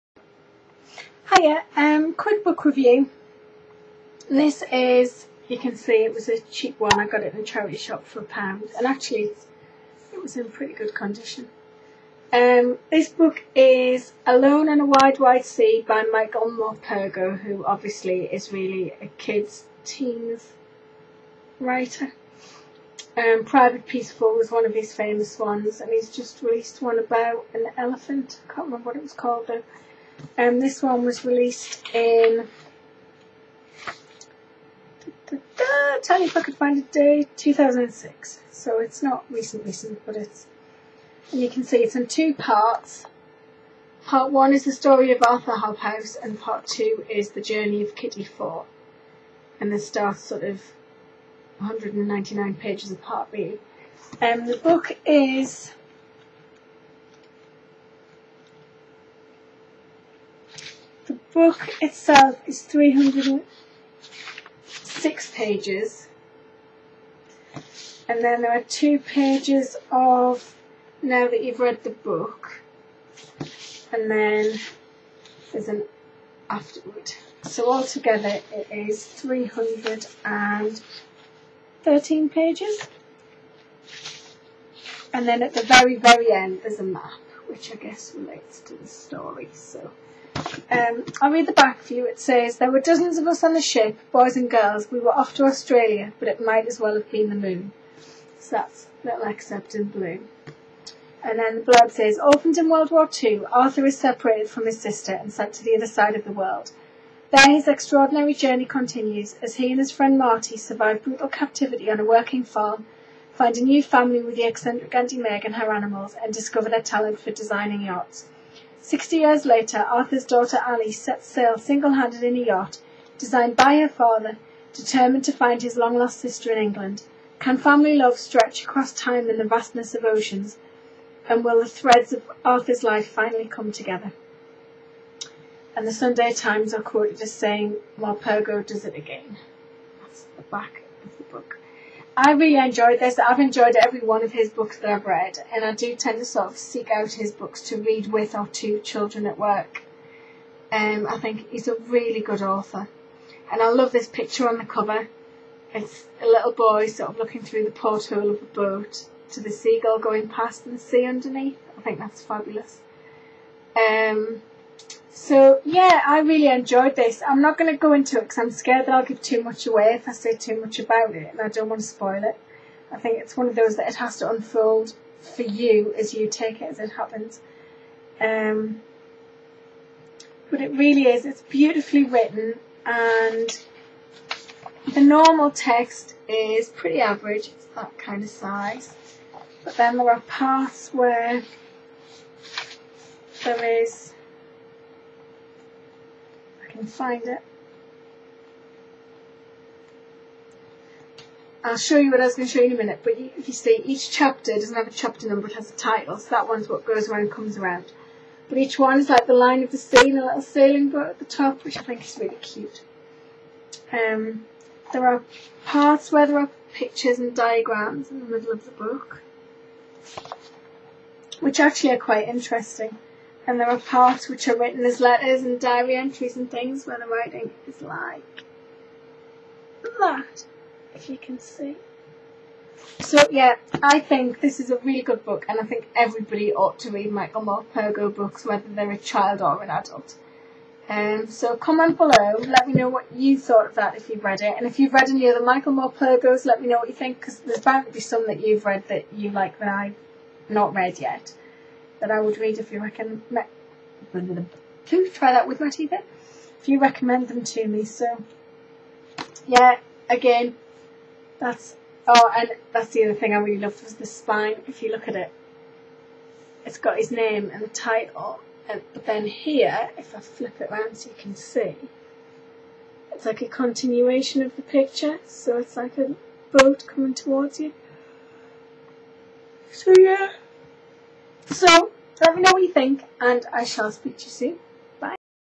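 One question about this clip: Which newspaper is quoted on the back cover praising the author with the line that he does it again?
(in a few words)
The Sunday Times.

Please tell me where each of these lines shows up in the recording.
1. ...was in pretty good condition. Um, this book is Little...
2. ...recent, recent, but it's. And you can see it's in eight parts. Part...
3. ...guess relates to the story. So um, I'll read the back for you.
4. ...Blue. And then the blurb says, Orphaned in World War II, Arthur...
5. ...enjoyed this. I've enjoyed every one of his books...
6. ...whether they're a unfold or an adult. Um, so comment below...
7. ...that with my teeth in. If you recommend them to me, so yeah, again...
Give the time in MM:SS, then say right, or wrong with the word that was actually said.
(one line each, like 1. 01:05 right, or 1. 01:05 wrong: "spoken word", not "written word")
1. 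00:10 wrong: "Alone", not "Little"
2. 00:39 wrong: "two", not "eight"
3. 01:27 right
4. 01:39 right
5. 02:22 right
6. 03:58 wrong: "child", not "unfold"
7. 04:15 right.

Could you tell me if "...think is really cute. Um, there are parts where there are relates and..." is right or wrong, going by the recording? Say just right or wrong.
wrong.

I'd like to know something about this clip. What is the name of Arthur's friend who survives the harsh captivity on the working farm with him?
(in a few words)
Marty.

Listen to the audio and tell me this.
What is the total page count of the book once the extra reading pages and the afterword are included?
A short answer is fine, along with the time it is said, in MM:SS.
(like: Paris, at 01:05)
313, at 01:19.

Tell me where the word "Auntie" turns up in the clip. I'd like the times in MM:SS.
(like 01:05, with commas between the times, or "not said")
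01:54.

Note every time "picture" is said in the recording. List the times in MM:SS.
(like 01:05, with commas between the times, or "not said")
02:34, 03:36, 04:34.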